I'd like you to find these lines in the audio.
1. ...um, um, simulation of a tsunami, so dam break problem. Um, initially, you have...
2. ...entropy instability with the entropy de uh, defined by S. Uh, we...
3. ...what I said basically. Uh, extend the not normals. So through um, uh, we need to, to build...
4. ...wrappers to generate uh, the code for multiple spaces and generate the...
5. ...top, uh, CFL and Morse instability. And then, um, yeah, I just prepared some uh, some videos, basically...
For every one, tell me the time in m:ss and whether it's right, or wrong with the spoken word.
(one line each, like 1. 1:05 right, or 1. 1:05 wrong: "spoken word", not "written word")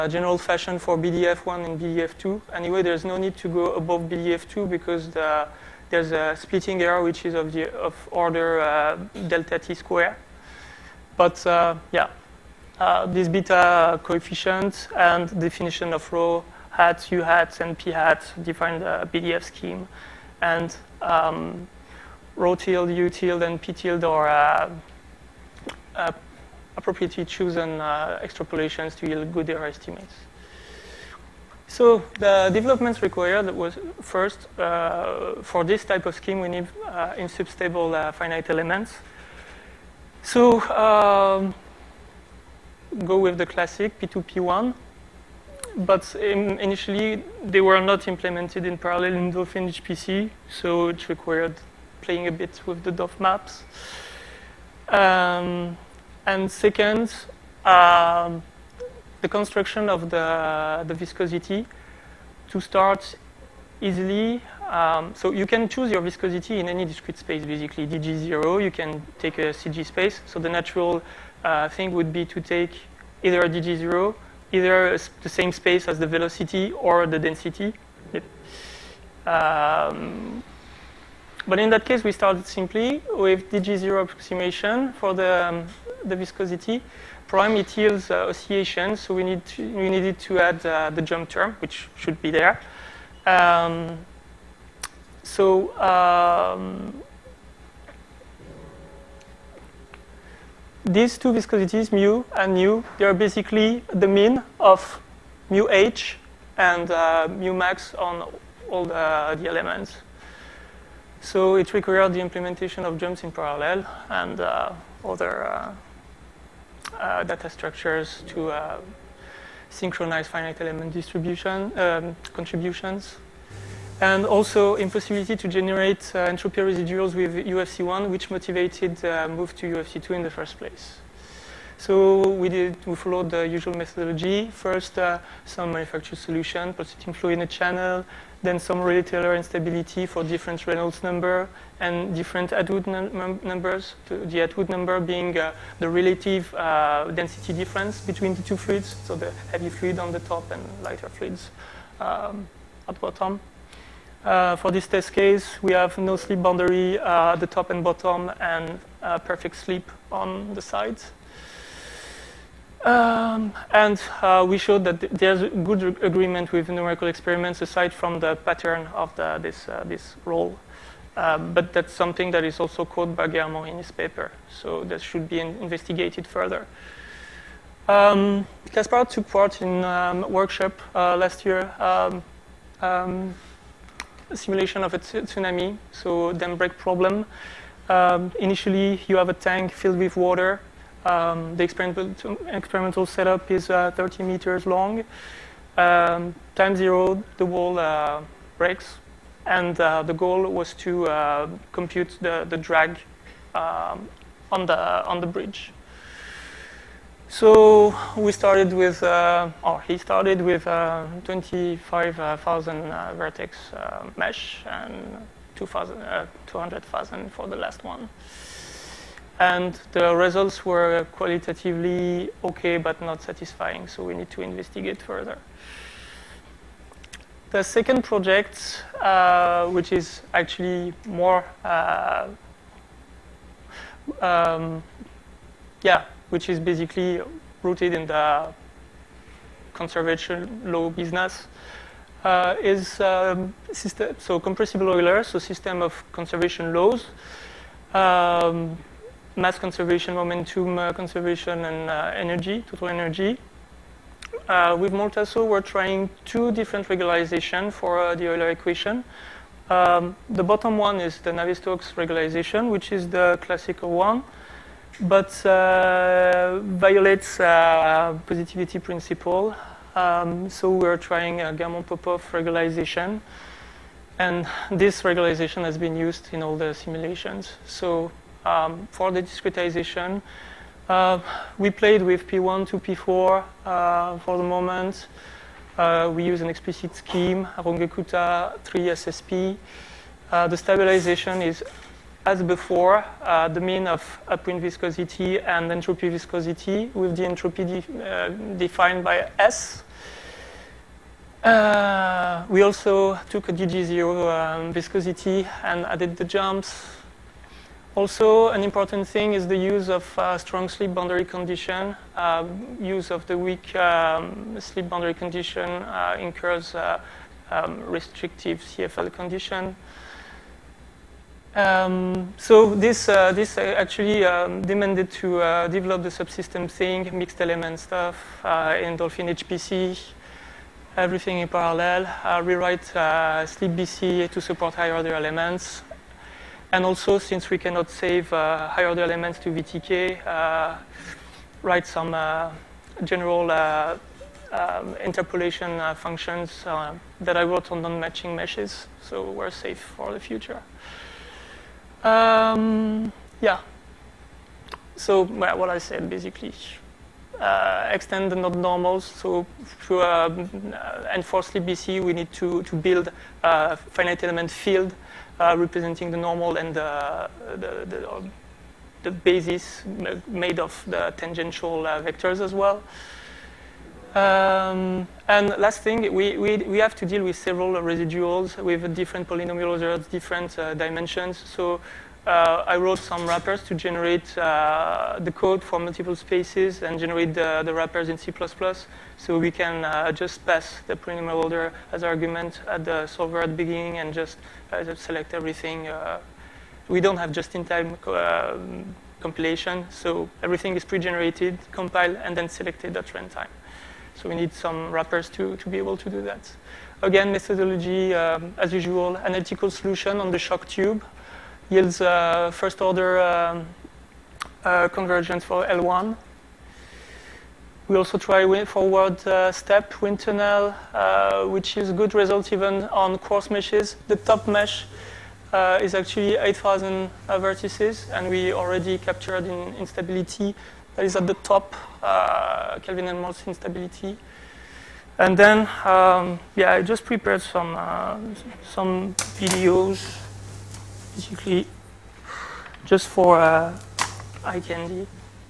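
1. 3:01 right
2. 4:55 wrong: "viscosity", not "instability"
3. 5:55 right
4. 6:23 right
5. 7:11 wrong: "Kelvin", not "CFL".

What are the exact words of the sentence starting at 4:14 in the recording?
Uh, with Murtazo, we're trying two different regularization for uh, the Euler equation.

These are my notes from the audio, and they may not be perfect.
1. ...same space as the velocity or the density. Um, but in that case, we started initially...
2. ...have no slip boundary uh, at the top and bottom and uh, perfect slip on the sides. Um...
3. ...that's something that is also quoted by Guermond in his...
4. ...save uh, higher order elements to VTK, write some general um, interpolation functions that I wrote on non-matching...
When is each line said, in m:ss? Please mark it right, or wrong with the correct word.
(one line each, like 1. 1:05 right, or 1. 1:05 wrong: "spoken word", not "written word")
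1. 1:15 wrong: "simply", not "initially"
2. 2:35 right
3. 2:51 right
4. 5:37 right.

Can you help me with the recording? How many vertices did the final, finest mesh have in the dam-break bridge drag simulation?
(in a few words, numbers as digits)
200,000.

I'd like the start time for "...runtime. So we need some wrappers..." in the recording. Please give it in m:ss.
6:43.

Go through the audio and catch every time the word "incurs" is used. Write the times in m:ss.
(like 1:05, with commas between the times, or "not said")
5:16.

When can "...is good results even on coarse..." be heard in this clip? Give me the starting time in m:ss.
7:01.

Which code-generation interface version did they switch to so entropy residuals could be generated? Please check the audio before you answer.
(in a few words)
UFC2.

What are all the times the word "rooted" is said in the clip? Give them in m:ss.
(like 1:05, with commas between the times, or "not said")
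3:57.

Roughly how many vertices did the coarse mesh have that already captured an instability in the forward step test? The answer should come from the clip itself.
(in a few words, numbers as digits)
8,000.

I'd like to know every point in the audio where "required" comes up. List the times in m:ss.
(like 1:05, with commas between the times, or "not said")
0:33, 0:51, 1:51.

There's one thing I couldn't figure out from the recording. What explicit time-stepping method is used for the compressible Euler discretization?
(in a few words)
Runge-Kutta 3 SSP.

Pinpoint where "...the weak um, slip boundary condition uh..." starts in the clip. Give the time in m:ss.
5:13.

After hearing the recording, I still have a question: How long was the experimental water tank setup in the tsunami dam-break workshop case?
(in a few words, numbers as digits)
30 meters.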